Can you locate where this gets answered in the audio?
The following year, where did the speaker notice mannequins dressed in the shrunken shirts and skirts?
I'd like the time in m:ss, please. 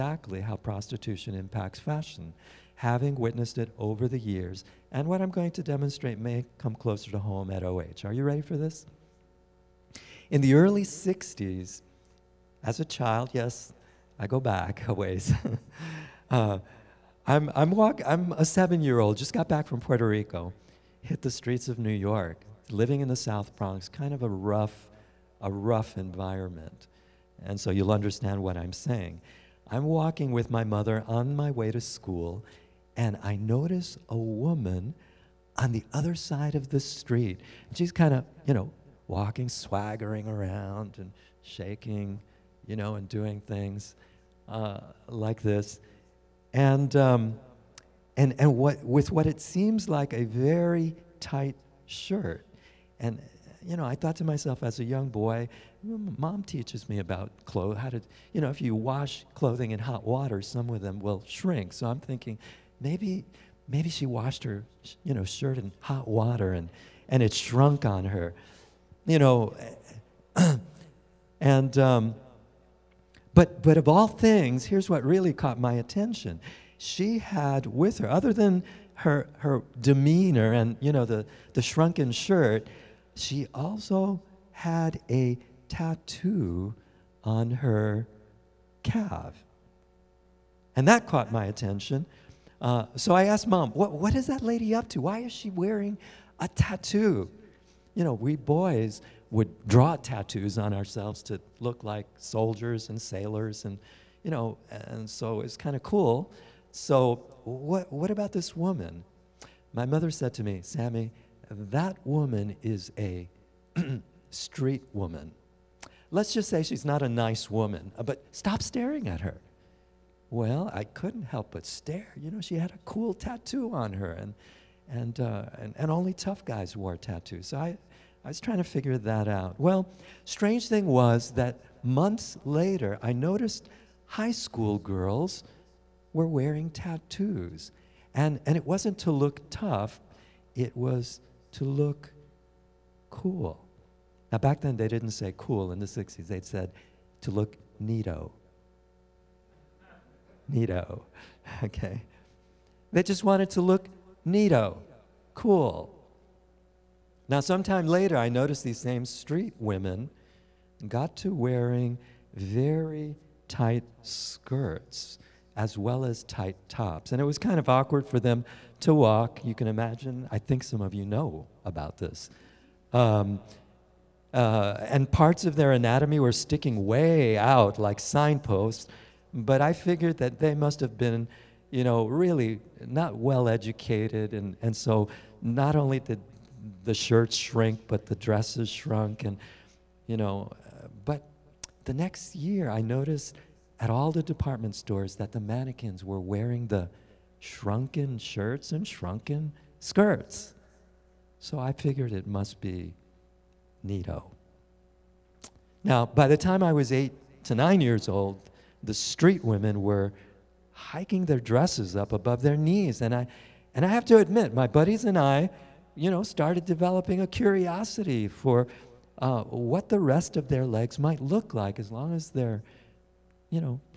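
3:14.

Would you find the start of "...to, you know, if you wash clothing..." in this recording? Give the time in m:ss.
0:57.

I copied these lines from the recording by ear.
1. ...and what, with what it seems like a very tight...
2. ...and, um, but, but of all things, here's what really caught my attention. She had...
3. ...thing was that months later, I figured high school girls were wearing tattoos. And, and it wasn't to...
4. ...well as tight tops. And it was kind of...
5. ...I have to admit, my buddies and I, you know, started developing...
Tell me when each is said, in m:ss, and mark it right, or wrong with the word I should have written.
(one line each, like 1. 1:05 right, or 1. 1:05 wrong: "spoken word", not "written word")
1. 0:48 right
2. 1:11 right
3. 2:10 wrong: "noticed", not "figured"
4. 2:45 right
5. 3:33 right.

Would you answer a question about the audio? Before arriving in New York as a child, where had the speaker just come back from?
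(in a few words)
Puerto Rico.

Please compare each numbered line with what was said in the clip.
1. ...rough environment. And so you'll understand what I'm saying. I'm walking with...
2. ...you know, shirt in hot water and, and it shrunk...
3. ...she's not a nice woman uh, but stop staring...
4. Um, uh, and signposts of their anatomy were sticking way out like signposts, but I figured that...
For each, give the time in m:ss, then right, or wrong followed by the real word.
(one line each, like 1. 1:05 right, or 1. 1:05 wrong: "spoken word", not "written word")
1. 0:25 right
2. 1:05 right
3. 1:56 right
4. 2:52 wrong: "parts", not "signposts".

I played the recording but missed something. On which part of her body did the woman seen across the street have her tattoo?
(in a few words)
Her calf.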